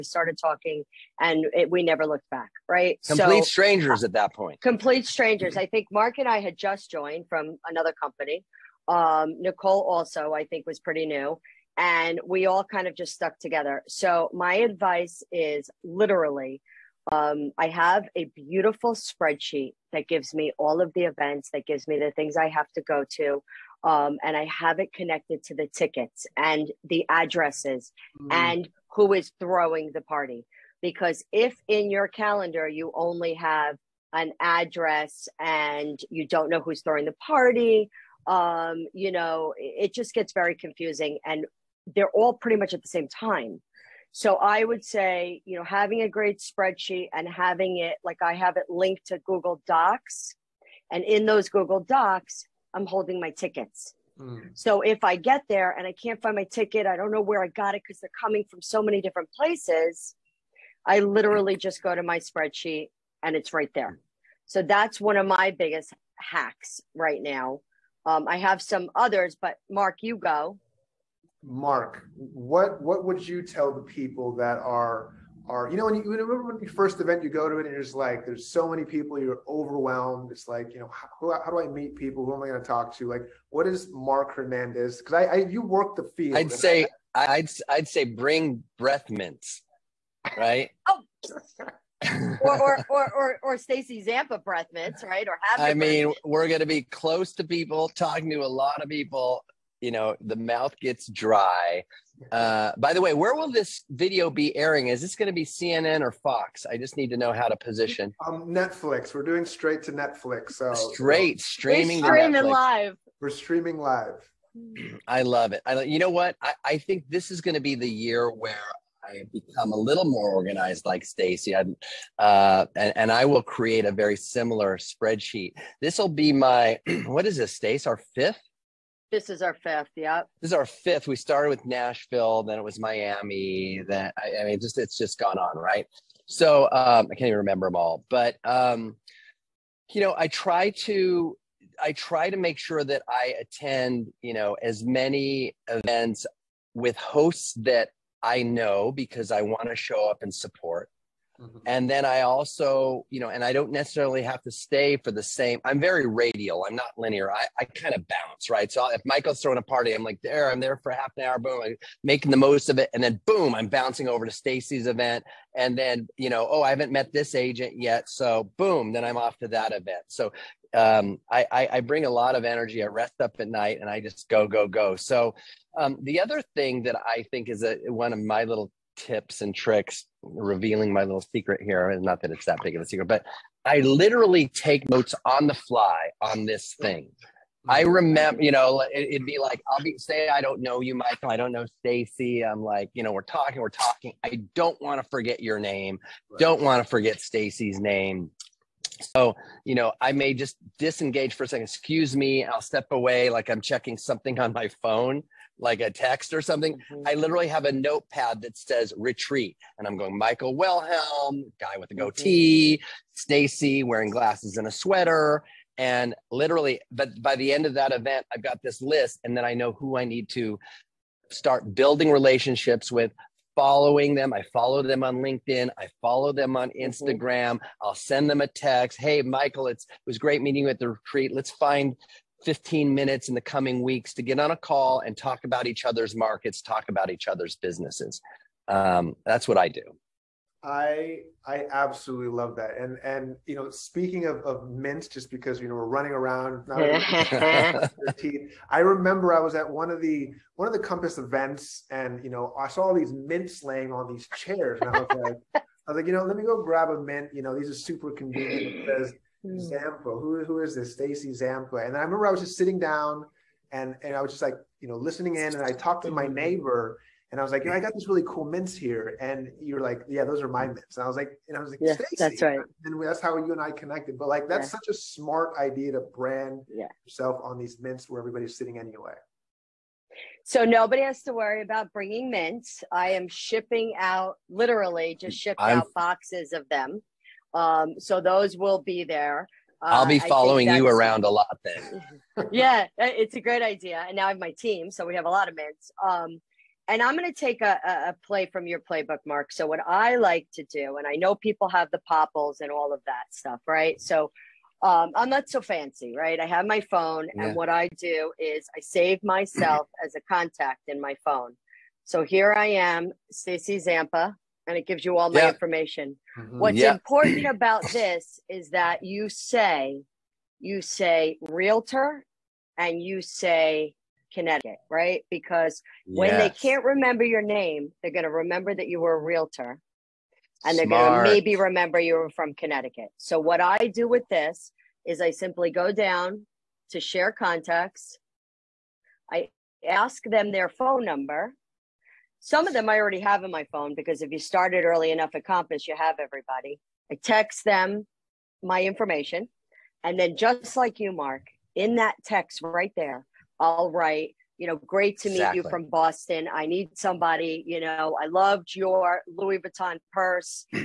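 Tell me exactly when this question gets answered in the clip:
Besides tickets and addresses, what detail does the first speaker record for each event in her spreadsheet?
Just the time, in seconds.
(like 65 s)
28 s.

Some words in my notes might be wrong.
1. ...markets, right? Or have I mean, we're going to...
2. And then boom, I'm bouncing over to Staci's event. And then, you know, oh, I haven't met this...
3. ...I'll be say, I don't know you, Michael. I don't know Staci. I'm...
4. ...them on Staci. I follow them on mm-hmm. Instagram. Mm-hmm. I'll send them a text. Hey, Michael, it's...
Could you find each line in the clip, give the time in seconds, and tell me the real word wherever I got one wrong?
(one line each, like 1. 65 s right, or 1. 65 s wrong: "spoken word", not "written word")
1. 94 s wrong: "mints", not "markets"
2. 162 s right
3. 189 s right
4. 224 s wrong: "LinkedIn", not "Staci".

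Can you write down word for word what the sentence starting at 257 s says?
You know, these are super convenient.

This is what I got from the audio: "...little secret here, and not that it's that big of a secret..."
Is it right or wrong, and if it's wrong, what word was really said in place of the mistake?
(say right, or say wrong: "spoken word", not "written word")
right.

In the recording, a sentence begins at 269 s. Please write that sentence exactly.
And you're like, yeah, those are my mints.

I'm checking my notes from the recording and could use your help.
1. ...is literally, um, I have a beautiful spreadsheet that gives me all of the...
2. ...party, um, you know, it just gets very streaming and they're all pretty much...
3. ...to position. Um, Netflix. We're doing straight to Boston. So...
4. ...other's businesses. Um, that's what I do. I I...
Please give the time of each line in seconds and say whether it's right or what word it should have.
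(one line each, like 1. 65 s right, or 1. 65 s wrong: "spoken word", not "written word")
1. 15 s right
2. 37 s wrong: "confusing", not "streaming"
3. 107 s wrong: "Netflix", not "Boston"
4. 237 s right.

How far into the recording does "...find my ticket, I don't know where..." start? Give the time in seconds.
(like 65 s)
56 s.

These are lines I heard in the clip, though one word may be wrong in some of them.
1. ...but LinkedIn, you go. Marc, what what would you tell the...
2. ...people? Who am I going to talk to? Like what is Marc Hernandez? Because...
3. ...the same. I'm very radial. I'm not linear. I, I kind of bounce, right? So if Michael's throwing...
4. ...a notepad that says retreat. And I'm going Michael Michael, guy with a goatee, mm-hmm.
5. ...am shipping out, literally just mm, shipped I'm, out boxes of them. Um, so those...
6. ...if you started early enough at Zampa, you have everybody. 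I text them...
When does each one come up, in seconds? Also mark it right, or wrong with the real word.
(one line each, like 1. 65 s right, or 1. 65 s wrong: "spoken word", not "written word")
1. 69 s wrong: "Marc", not "LinkedIn"
2. 81 s right
3. 155 s right
4. 207 s wrong: "Wilhelm", not "Michael"
5. 283 s right
6. 344 s wrong: "Compass", not "Zampa".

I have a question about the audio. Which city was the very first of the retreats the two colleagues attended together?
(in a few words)
Nashville.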